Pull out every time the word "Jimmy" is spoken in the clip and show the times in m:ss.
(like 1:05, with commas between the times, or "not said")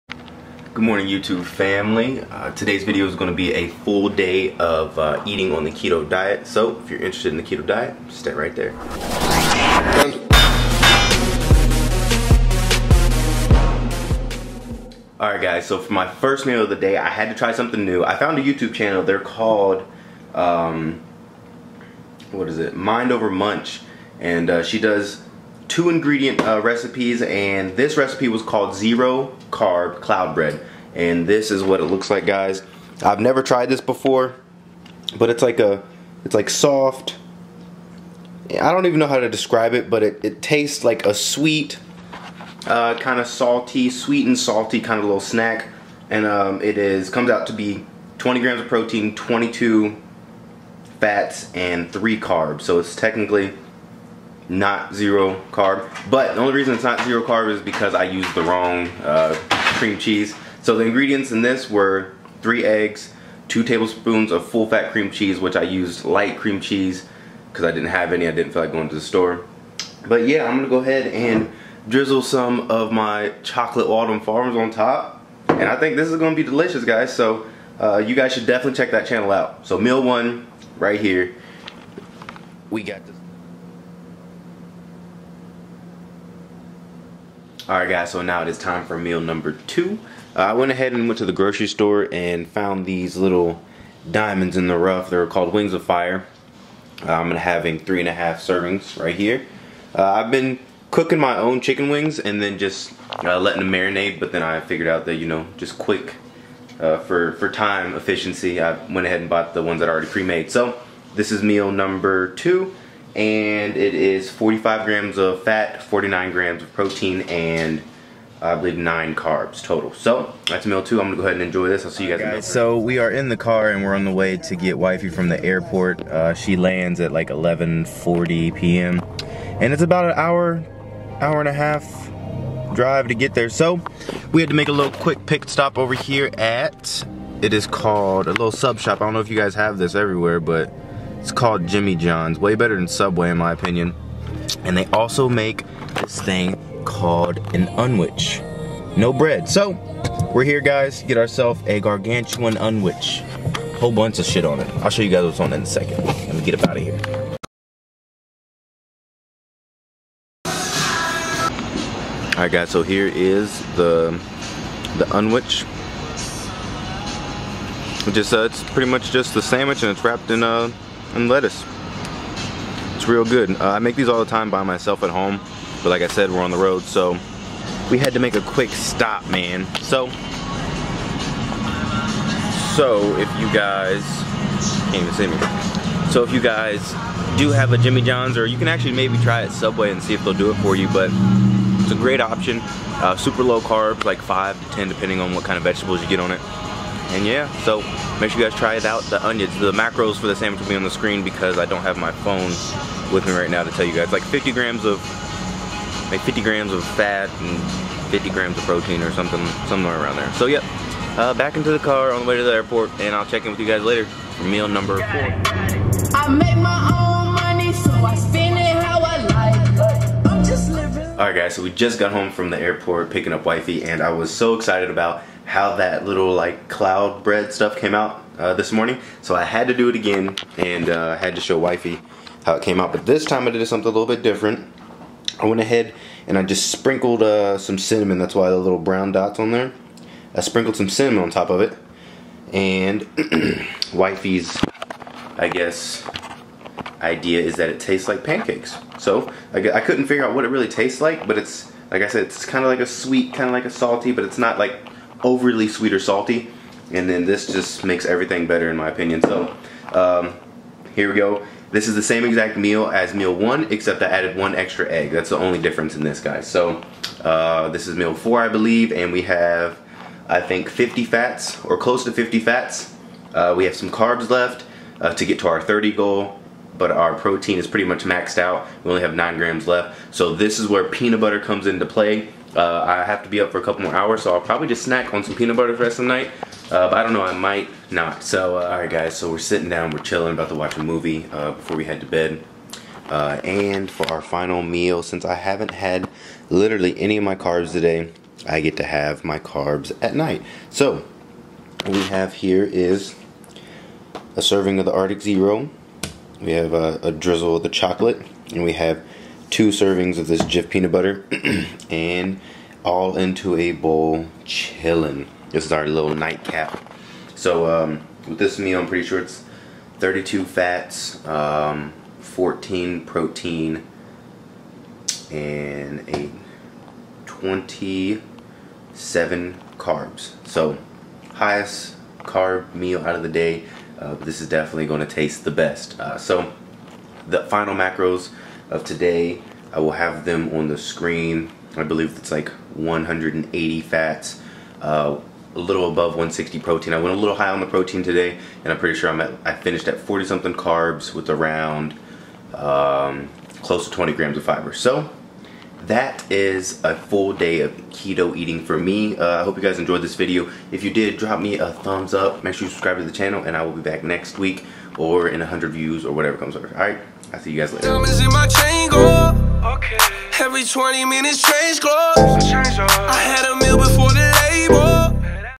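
2:21, 3:07.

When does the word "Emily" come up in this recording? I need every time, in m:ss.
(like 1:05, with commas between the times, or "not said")
not said.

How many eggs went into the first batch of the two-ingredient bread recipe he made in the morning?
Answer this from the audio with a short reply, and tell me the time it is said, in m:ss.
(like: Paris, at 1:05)
3, at 1:02.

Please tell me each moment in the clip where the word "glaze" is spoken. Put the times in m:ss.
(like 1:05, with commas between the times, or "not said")
not said.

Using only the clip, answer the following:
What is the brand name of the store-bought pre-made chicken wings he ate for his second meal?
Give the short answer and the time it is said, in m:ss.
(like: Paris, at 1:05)
Wings of Fire, at 1:35.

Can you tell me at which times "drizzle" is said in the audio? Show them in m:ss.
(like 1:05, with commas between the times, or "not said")
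1:11, 5:07.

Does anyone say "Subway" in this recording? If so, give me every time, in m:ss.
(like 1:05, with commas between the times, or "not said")
2:22, 3:09.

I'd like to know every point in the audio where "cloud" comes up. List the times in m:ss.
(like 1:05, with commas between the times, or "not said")
0:30, 3:46.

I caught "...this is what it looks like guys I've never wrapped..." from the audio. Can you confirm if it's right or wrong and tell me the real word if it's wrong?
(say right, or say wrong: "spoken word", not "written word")
wrong: "tried", not "wrapped".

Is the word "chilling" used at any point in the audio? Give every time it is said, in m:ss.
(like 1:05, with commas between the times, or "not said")
4:49, 5:14.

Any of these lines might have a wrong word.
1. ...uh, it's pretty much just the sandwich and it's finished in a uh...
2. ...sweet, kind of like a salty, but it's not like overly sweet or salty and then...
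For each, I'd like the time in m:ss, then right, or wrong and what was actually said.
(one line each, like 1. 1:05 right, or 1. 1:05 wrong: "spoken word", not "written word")
1. 2:48 wrong: "wrapped", not "finished"
2. 4:12 right.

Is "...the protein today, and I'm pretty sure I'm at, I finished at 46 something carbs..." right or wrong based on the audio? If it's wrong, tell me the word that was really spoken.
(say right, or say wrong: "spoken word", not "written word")
wrong: "40", not "46".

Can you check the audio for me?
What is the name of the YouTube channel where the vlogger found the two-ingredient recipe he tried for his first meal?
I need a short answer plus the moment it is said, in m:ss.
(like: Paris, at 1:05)
Mind Over Munch, at 0:22.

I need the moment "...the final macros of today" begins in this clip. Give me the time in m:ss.
5:37.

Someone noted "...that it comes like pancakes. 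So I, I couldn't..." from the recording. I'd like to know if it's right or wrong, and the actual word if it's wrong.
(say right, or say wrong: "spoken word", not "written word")
wrong: "tastes", not "comes".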